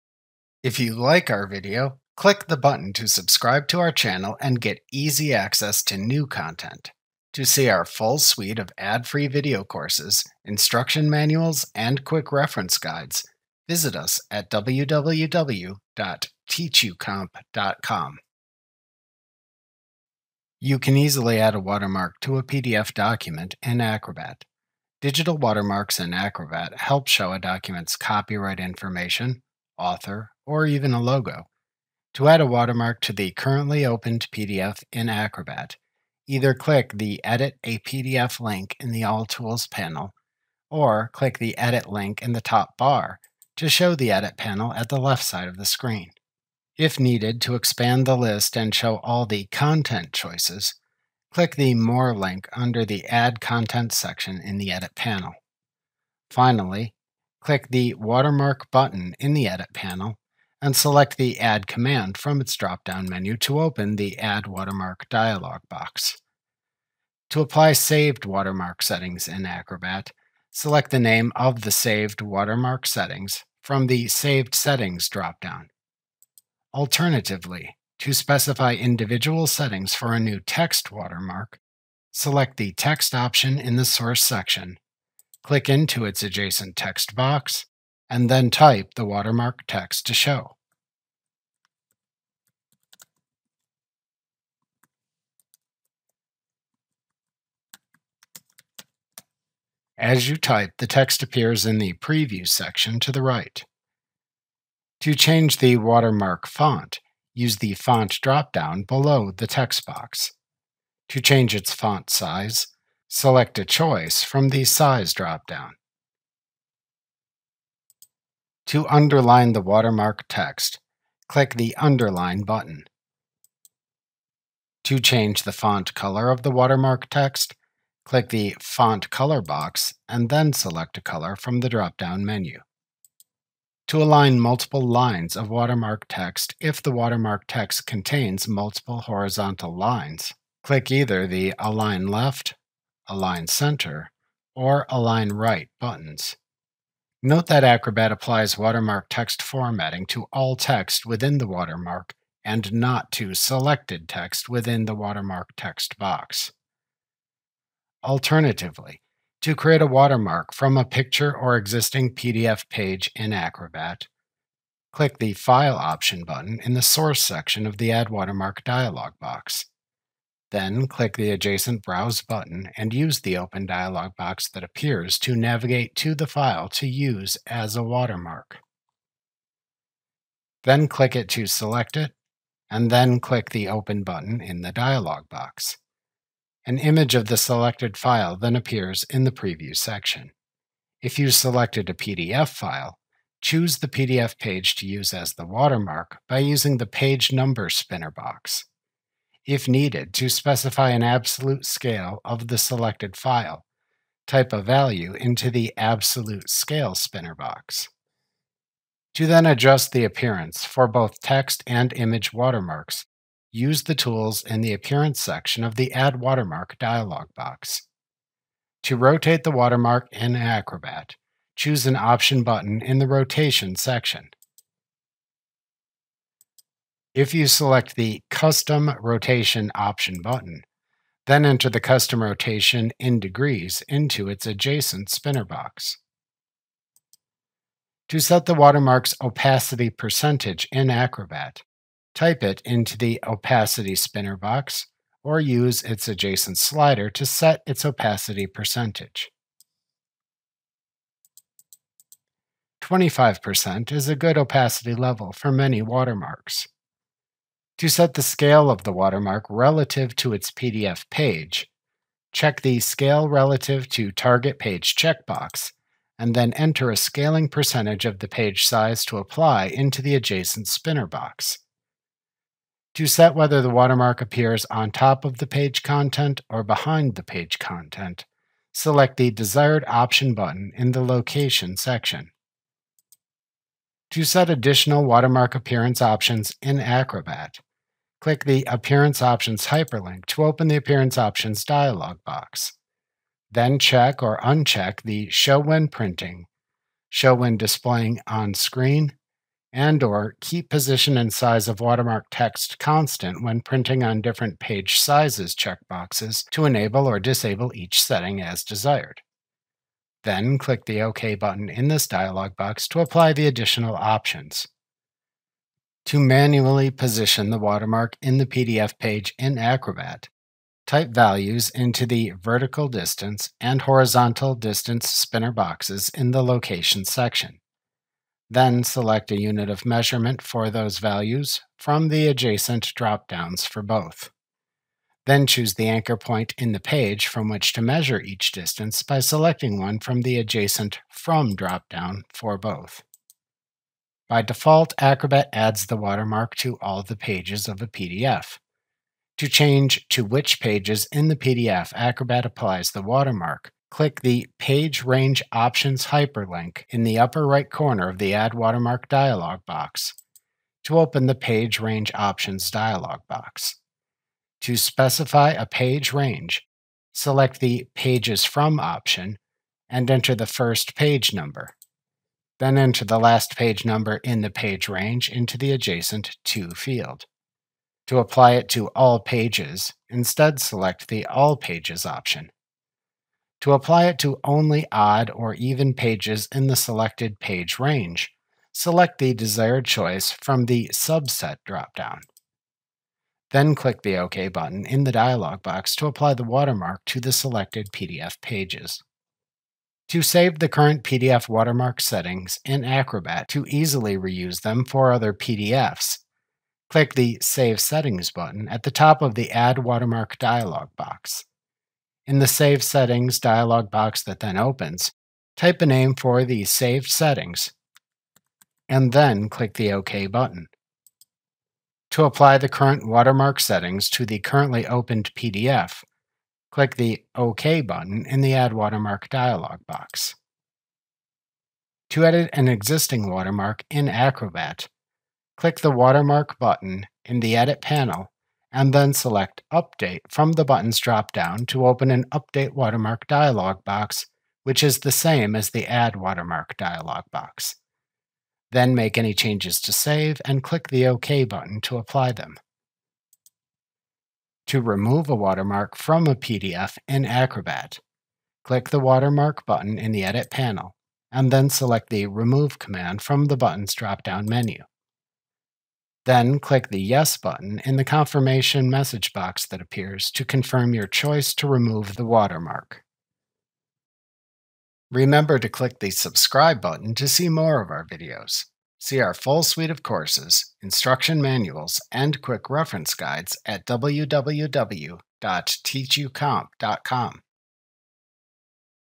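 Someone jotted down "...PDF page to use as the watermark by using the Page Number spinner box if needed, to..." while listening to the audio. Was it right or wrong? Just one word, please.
right.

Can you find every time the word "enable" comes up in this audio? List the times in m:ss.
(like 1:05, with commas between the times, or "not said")
5:06.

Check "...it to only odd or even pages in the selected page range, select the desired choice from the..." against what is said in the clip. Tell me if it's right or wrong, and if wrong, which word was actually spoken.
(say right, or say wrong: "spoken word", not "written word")
right.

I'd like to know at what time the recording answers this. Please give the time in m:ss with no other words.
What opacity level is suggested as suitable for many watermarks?
4:12.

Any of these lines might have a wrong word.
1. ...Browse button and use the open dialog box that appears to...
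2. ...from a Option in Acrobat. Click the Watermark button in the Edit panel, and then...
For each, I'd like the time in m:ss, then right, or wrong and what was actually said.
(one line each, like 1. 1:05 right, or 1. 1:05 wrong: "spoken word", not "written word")
1. 2:51 right
2. 7:35 wrong: "PDF", not "Option".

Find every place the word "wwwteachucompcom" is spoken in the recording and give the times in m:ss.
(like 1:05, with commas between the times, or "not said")
0:14, 8:03.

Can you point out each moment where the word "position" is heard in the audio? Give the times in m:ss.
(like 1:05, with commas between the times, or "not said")
5:00, 5:16.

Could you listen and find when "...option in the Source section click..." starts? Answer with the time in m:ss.
1:23.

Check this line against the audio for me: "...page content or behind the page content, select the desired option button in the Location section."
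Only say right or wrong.
right.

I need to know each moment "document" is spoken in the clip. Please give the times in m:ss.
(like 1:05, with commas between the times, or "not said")
0:22, 0:27.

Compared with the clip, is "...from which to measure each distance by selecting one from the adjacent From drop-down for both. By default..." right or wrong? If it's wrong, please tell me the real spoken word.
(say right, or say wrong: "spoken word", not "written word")
right.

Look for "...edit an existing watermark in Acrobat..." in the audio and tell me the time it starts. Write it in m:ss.
7:12.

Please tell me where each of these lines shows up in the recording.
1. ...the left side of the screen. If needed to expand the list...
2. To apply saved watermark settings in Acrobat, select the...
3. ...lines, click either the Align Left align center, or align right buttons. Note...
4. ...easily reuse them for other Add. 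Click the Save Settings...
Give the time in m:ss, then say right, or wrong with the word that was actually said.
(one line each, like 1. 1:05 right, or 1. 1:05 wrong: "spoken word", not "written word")
1. 0:44 right
2. 1:07 right
3. 2:19 right
4. 6:43 wrong: "PDFs", not "Add".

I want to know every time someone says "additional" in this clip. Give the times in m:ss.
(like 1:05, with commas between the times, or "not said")
4:44, 5:13.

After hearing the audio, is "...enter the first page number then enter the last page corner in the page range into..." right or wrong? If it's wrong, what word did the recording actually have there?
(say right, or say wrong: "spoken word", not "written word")
wrong: "number", not "corner".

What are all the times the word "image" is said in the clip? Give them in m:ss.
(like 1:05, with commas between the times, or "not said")
3:06, 3:31.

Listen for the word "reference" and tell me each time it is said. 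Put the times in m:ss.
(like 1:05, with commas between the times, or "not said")
0:12, 8:02.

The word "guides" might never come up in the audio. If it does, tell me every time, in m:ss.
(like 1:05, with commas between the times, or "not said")
0:12, 8:03.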